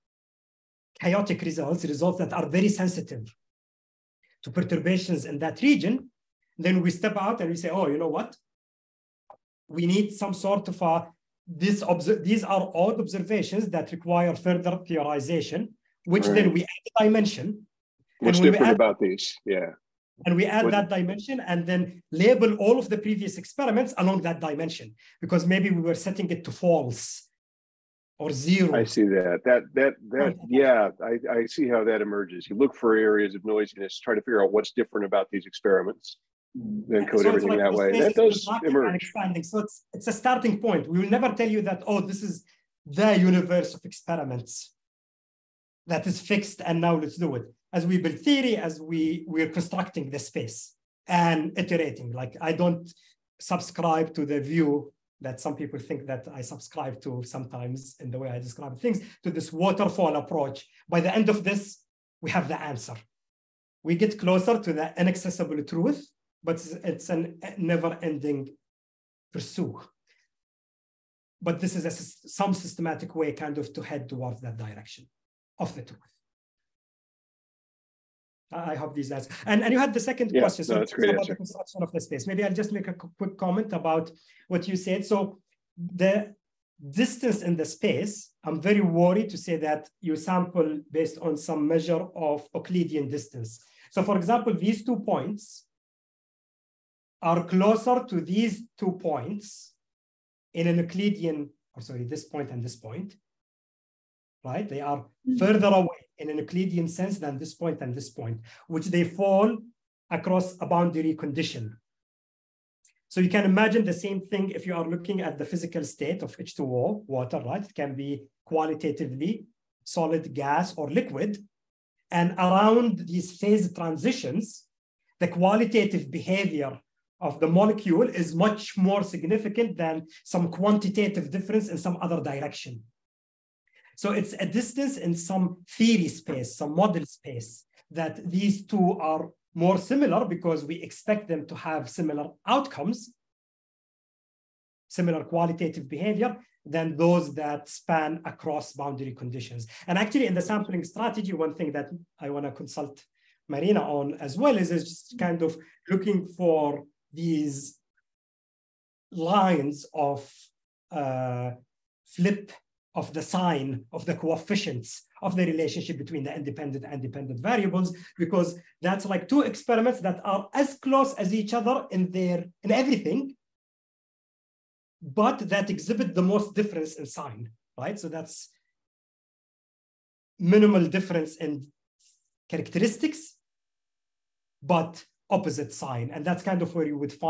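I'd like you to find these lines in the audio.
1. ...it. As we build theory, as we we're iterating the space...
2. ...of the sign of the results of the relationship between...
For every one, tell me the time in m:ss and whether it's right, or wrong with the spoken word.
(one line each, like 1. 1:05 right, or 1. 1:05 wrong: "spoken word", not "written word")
1. 0:47 wrong: "constructing", not "iterating"
2. 2:42 wrong: "coefficients", not "results".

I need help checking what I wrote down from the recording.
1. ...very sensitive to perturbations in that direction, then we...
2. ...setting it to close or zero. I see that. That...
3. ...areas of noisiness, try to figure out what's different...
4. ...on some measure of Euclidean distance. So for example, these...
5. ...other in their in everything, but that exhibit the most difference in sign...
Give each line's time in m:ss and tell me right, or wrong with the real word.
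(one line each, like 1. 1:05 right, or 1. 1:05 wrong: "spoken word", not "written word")
1. 0:02 wrong: "region", not "direction"
2. 0:25 wrong: "false", not "close"
3. 0:32 right
4. 1:31 right
5. 2:51 right.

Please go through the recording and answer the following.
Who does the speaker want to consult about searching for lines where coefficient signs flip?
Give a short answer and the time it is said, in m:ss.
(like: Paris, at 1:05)
Marina, at 2:33.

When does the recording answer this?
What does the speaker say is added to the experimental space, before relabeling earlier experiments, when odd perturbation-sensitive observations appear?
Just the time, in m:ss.
0:16.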